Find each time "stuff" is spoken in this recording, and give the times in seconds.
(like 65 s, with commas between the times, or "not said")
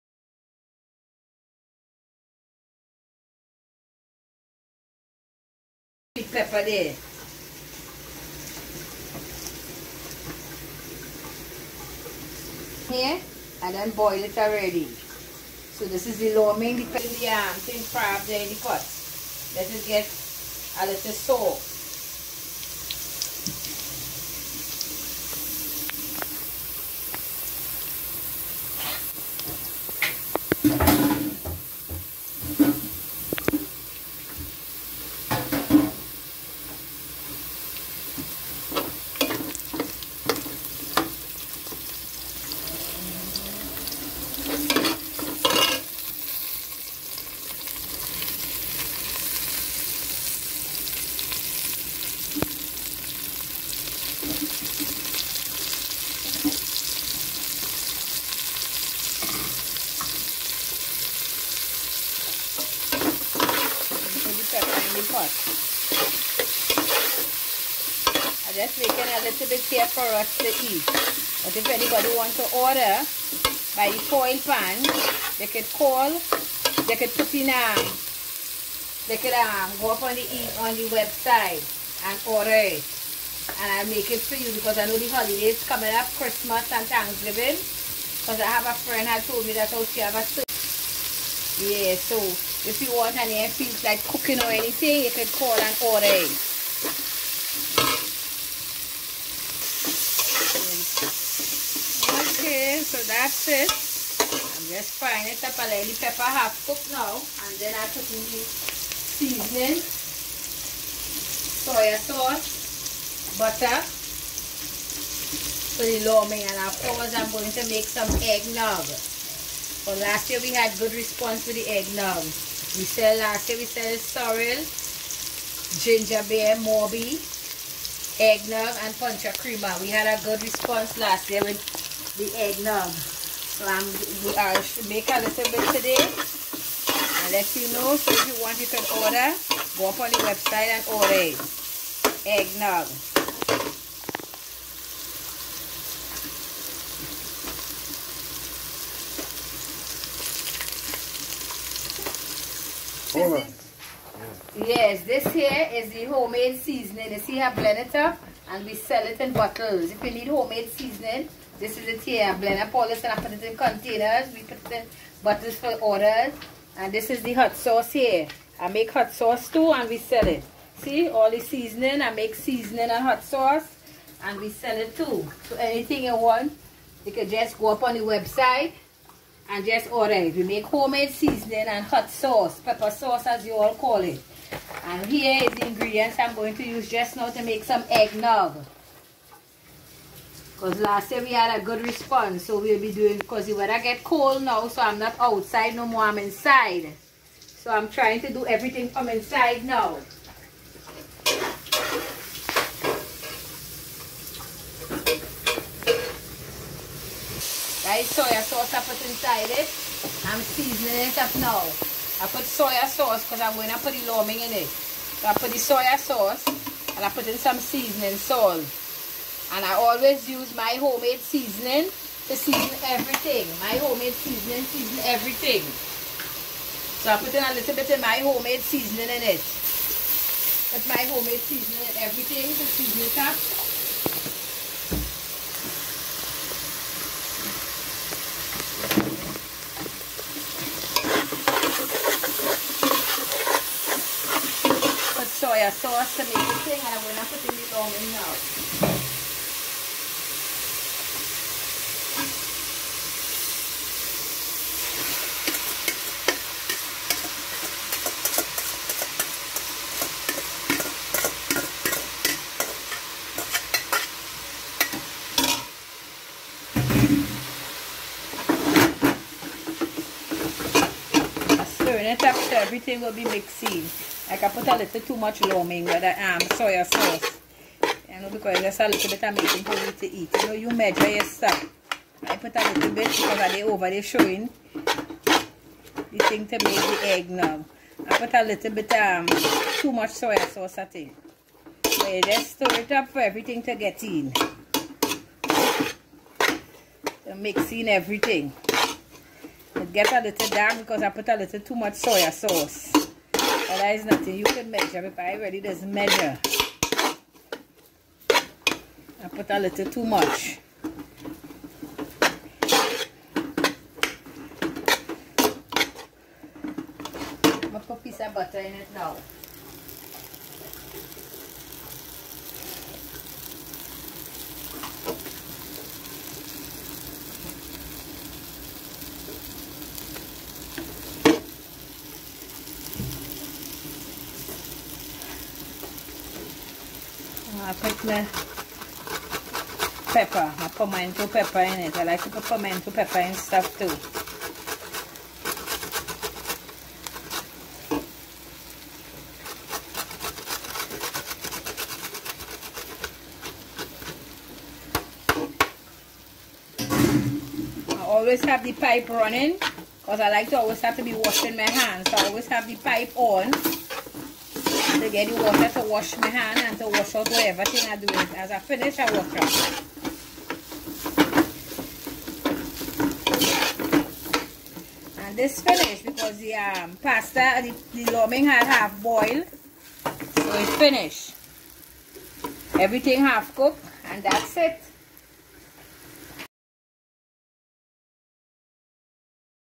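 281 s, 343 s.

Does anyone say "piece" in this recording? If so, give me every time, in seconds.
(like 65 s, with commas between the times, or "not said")
318 s.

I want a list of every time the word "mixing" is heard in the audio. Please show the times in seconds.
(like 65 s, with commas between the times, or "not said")
273 s, 297 s.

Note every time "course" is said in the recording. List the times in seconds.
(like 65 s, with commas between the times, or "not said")
116 s.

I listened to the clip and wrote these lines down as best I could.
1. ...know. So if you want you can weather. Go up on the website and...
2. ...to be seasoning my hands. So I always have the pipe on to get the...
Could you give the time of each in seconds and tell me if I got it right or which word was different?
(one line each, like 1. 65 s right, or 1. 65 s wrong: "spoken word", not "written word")
1. 137 s wrong: "order", not "weather"
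2. 360 s wrong: "washing", not "seasoning".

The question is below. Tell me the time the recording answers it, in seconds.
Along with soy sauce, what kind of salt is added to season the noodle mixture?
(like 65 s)
217 s.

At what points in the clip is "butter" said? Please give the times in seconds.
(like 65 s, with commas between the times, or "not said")
113 s, 318 s.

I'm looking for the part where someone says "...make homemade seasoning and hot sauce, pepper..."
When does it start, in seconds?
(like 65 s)
180 s.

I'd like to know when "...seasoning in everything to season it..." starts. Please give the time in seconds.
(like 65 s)
231 s.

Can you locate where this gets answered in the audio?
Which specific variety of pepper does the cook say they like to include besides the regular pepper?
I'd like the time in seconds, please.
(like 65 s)
342 s.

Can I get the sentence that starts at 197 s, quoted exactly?
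So I'm trying to do everything from inside now.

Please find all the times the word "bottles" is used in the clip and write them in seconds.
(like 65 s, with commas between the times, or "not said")
159 s, 165 s.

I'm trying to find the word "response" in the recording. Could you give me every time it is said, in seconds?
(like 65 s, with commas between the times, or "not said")
120 s, 130 s, 191 s.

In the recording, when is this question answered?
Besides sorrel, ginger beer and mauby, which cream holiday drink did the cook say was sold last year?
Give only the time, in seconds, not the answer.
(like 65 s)
129 s.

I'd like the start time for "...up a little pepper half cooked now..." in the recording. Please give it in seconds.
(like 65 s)
105 s.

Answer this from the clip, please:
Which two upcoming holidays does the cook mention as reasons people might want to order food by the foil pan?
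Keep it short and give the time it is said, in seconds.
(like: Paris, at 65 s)
Christmas and Thanksgiving, at 86 s.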